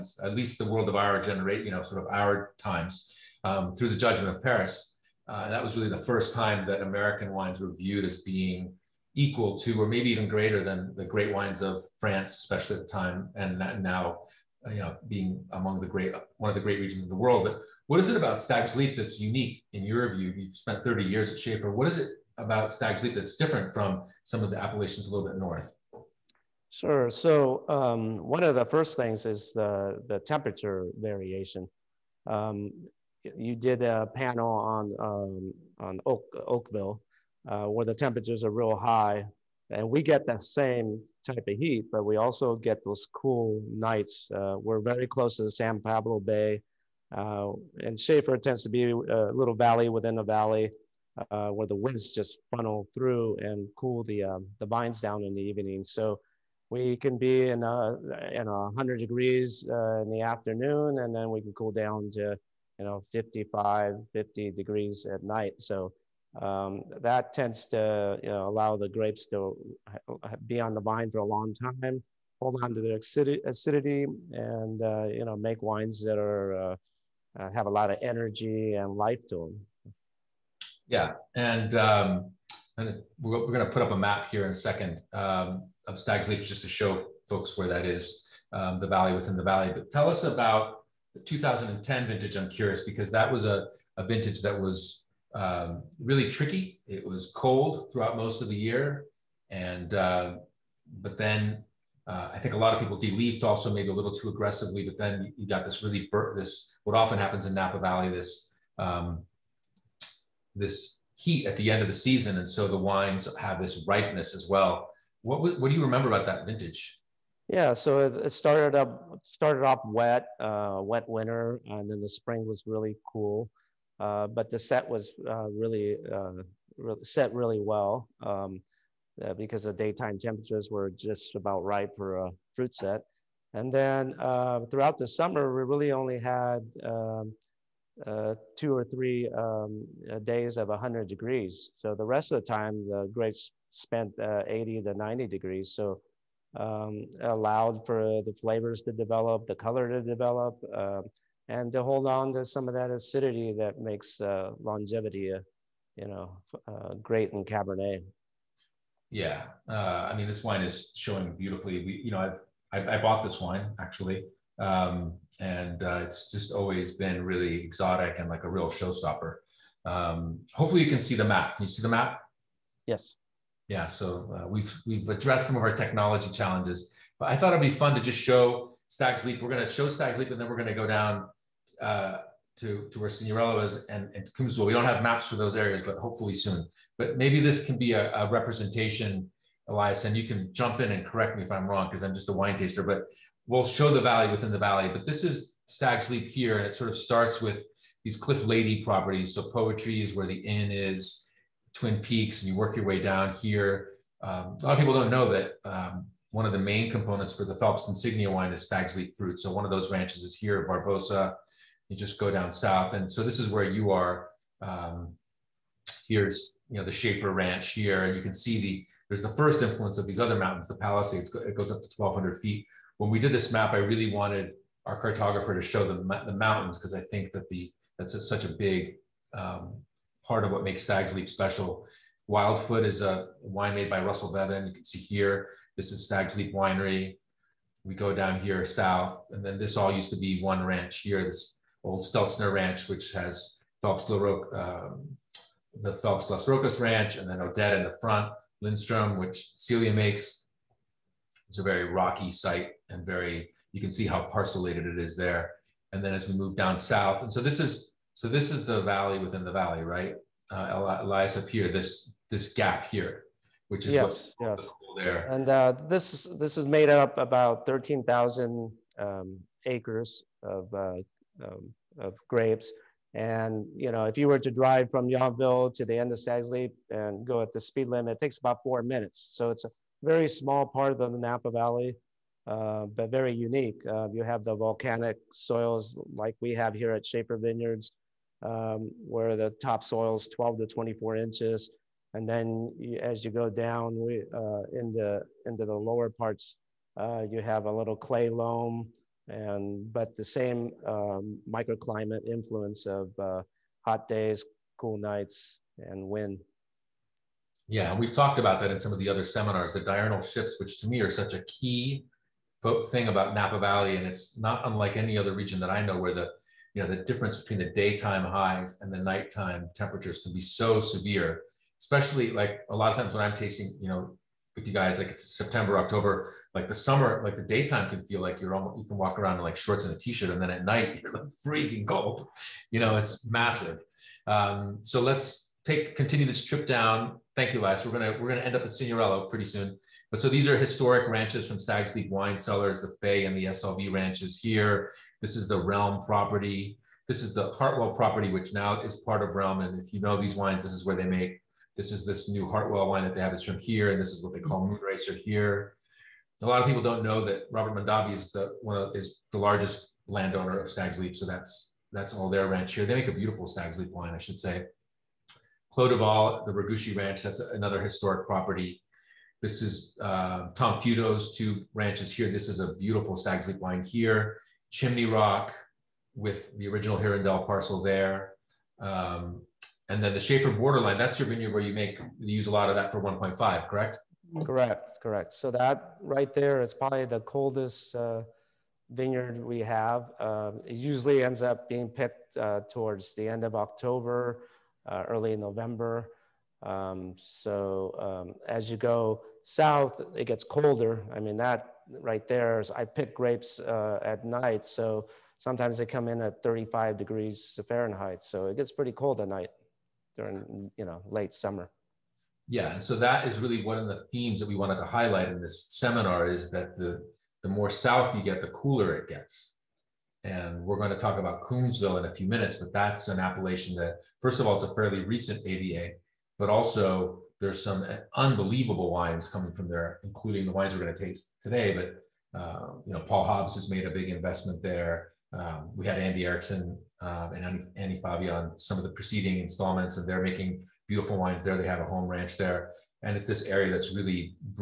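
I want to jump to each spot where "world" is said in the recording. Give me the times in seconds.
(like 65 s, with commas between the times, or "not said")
0 s, 17 s.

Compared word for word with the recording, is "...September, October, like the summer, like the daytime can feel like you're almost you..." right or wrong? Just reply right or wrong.
right.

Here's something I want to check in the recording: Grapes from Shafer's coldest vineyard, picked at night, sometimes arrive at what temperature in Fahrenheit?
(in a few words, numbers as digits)
35 degrees.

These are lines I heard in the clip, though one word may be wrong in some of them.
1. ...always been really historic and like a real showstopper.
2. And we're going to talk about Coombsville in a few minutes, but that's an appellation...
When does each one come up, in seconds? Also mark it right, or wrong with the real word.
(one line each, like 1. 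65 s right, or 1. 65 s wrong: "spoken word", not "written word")
1. 166 s wrong: "exotic", not "historic"
2. 420 s right.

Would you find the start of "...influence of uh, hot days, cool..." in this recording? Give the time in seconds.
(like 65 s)
302 s.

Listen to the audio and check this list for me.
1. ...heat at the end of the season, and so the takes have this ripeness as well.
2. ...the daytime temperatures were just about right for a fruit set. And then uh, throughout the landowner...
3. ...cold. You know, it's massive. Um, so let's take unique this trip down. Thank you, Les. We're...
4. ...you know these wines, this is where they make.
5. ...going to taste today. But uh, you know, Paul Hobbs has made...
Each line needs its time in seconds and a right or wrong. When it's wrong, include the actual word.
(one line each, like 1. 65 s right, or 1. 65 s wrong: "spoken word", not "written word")
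1. 111 s wrong: "wines", not "takes"
2. 129 s wrong: "summer", not "landowner"
3. 331 s wrong: "continue", not "unique"
4. 349 s right
5. 430 s right.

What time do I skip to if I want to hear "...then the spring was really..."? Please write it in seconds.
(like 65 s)
121 s.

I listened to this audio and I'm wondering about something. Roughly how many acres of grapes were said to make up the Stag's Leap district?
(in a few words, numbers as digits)
13,000.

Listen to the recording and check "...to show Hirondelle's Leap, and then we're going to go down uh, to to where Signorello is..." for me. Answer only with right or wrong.
wrong.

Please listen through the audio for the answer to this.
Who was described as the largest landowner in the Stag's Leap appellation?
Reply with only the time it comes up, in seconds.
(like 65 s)
357 s.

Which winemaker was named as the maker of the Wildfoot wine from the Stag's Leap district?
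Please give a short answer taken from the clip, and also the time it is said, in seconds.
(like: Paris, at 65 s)
Russell Bevan, at 234 s.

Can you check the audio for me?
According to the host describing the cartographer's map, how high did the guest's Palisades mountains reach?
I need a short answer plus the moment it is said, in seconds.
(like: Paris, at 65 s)
1,200 feet, at 221 s.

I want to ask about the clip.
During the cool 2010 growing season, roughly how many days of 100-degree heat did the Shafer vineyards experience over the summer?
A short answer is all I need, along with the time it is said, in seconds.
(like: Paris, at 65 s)
2 or 3, at 138 s.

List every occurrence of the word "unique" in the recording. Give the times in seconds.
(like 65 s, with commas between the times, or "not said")
19 s, 283 s.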